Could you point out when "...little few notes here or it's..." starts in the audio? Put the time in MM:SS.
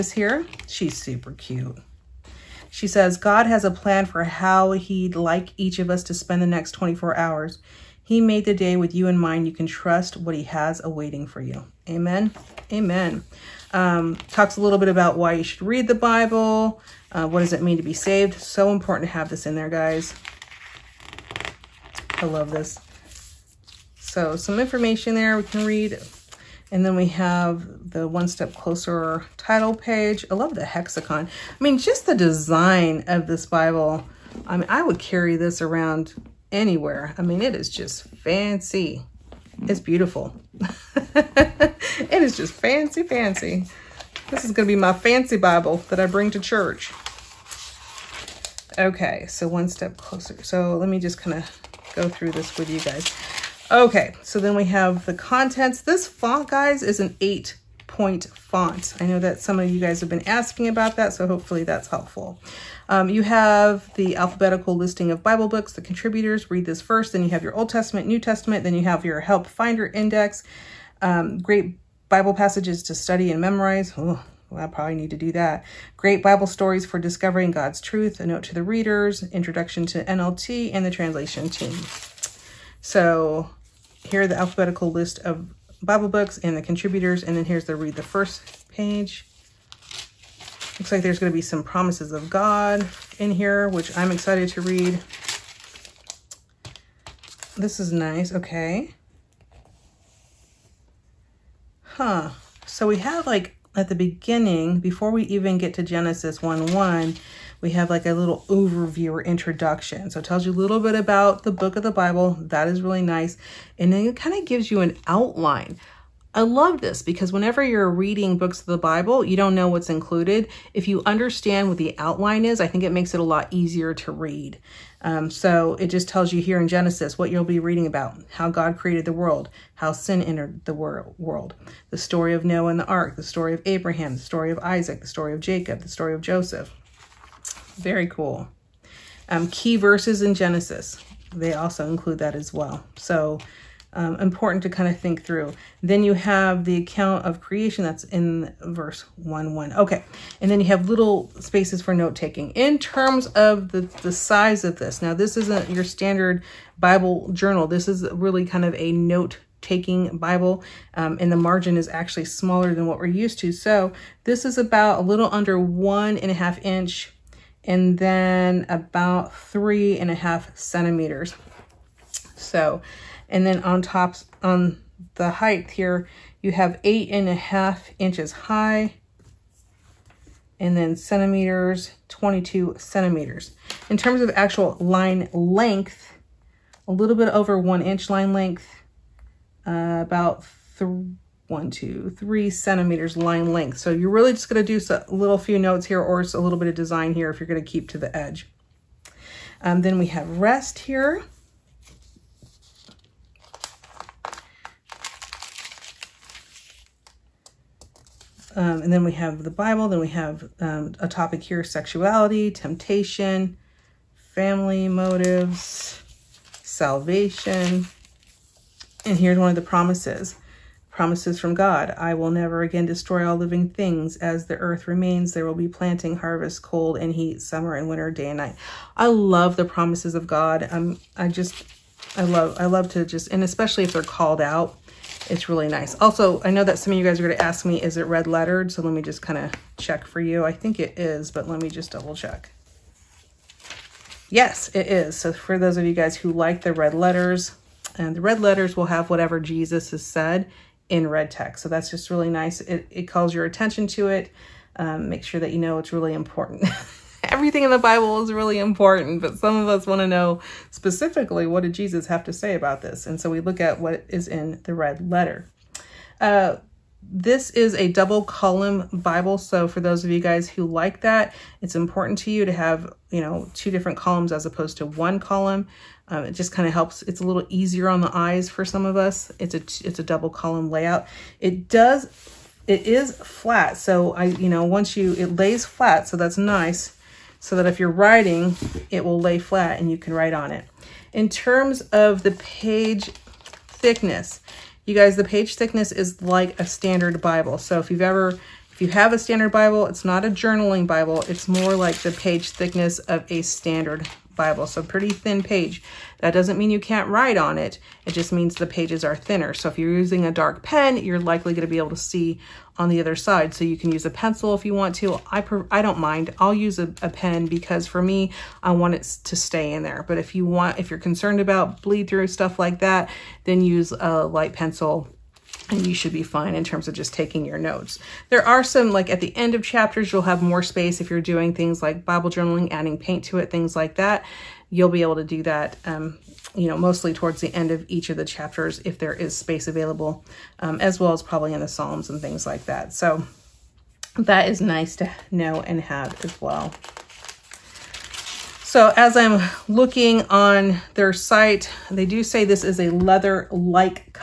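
03:15.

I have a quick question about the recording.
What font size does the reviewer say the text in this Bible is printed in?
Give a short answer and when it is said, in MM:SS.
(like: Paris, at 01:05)
8 point, at 00:57.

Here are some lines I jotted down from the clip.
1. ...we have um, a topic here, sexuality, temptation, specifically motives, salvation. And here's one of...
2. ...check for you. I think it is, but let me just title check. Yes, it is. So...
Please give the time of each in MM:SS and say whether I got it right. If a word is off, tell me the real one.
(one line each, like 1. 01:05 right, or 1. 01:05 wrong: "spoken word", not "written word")
1. 03:29 wrong: "family", not "specifically"
2. 03:59 wrong: "double", not "title".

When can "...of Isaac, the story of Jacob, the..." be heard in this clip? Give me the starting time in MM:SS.
02:14.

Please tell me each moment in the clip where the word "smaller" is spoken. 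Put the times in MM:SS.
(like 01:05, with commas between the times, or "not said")
02:42.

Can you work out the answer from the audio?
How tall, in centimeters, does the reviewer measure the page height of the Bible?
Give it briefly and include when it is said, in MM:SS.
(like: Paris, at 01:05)
22 centimeters, at 03:02.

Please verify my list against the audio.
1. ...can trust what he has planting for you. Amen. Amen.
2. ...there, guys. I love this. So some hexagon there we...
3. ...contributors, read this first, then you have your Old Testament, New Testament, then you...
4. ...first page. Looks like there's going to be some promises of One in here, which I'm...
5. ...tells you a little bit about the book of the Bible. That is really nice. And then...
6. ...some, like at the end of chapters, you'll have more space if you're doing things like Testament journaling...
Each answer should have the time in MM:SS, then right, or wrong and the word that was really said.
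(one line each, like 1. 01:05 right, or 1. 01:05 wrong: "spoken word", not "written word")
1. 00:09 wrong: "awaiting", not "planting"
2. 00:19 wrong: "information", not "hexagon"
3. 01:05 right
4. 01:28 wrong: "God", not "One"
5. 01:50 right
6. 05:28 wrong: "Bible", not "Testament".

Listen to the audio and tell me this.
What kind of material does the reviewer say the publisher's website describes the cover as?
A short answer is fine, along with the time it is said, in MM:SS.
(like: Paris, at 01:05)
Leather-like, at 05:52.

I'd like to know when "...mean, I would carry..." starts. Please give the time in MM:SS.
00:34.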